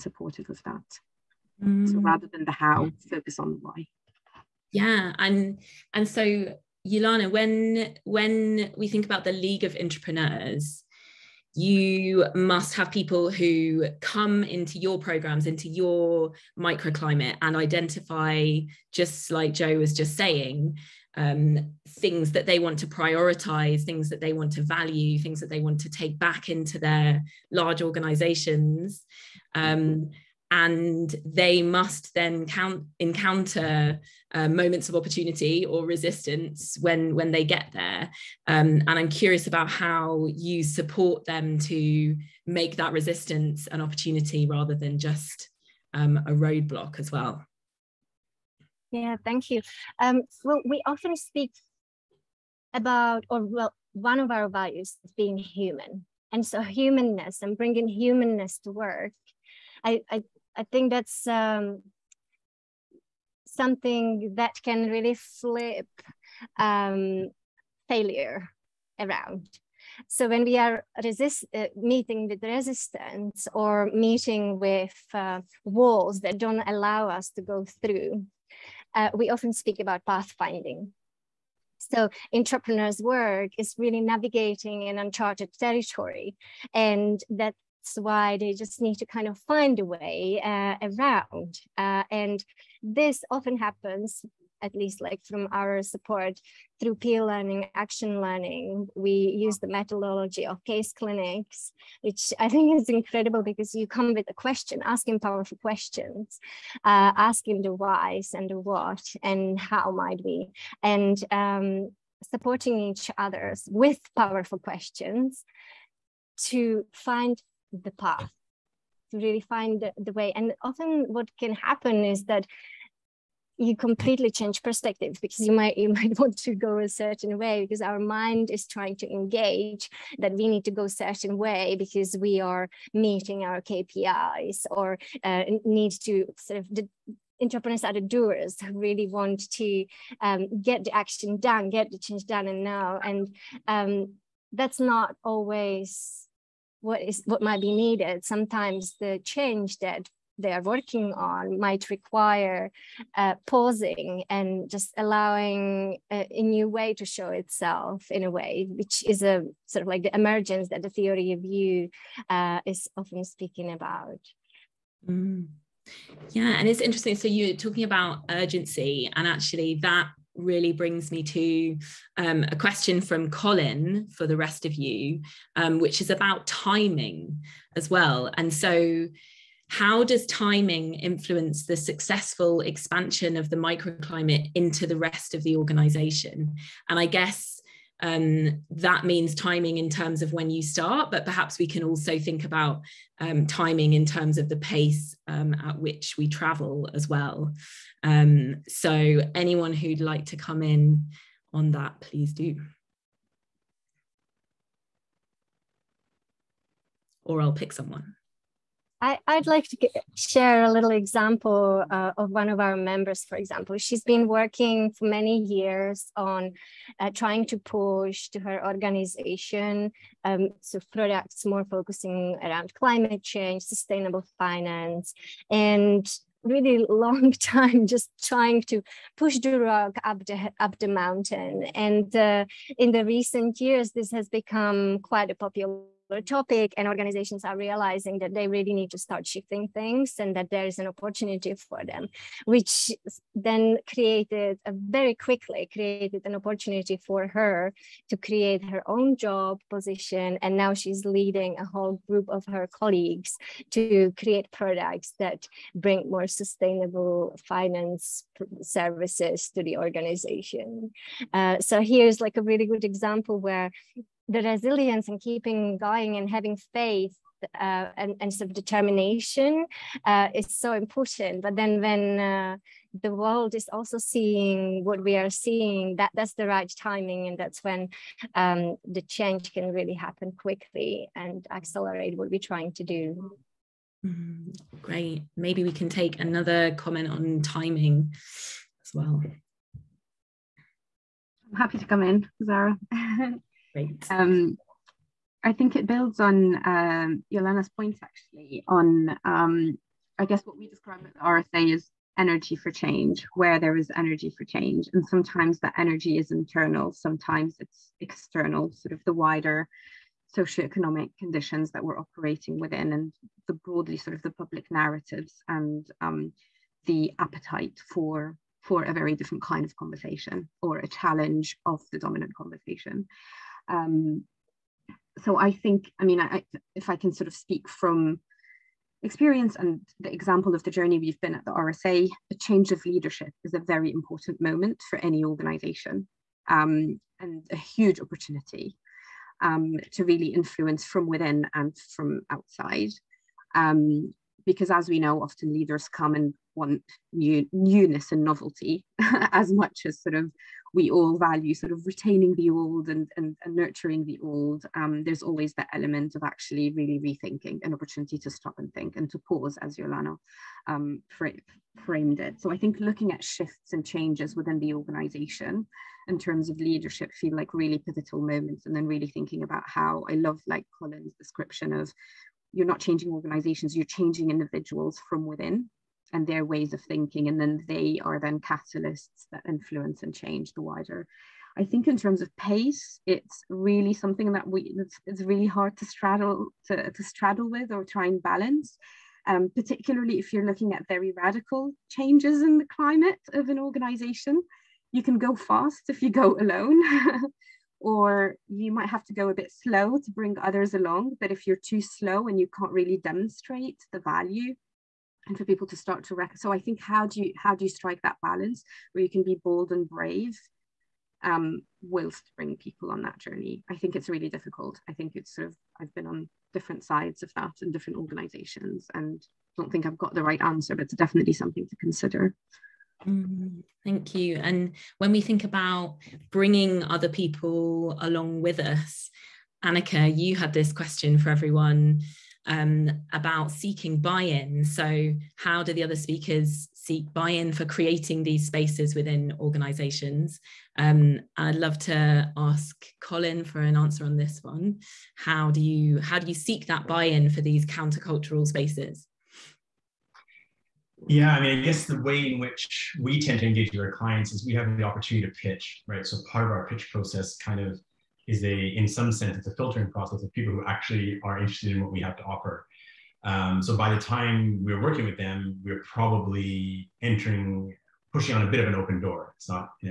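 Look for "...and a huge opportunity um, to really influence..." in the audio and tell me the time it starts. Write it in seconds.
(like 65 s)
337 s.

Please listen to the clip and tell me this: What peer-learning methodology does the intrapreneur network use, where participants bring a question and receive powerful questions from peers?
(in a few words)
case clinics.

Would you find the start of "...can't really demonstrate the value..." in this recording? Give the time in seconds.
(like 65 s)
402 s.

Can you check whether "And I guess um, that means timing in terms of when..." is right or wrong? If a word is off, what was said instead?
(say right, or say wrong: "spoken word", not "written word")
right.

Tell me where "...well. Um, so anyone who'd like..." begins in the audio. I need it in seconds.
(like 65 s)
197 s.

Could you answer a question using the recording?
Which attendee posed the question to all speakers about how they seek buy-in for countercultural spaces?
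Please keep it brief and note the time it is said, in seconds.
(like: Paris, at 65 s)
Anneka, at 429 s.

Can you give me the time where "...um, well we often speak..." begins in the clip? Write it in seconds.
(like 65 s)
49 s.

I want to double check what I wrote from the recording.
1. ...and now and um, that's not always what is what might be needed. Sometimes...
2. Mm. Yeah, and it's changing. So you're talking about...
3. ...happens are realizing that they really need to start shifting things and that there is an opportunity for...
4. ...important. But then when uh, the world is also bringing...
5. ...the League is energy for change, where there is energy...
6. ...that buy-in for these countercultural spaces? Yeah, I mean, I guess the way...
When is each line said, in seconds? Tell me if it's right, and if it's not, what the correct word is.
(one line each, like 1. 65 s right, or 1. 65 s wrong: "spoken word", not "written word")
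1. 142 s right
2. 165 s wrong: "interesting", not "changing"
3. 236 s wrong: "organizations", not "happens"
4. 270 s wrong: "seeing", not "bringing"
5. 301 s wrong: "RSA", not "League"
6. 446 s right.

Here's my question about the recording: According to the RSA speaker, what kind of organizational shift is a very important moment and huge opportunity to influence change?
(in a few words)
change of leadership.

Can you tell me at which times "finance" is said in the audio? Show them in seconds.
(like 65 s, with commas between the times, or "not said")
224 s, 257 s.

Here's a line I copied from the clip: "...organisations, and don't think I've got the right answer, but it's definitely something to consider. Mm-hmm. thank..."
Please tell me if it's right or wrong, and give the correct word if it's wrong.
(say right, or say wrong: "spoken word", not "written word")
right.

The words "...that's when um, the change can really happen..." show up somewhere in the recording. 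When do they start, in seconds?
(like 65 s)
277 s.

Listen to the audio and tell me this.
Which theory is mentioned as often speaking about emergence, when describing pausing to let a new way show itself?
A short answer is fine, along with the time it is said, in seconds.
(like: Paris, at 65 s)
theory of you, at 160 s.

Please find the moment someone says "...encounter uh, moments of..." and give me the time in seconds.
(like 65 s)
32 s.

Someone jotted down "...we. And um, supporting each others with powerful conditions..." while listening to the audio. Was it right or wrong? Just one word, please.
wrong.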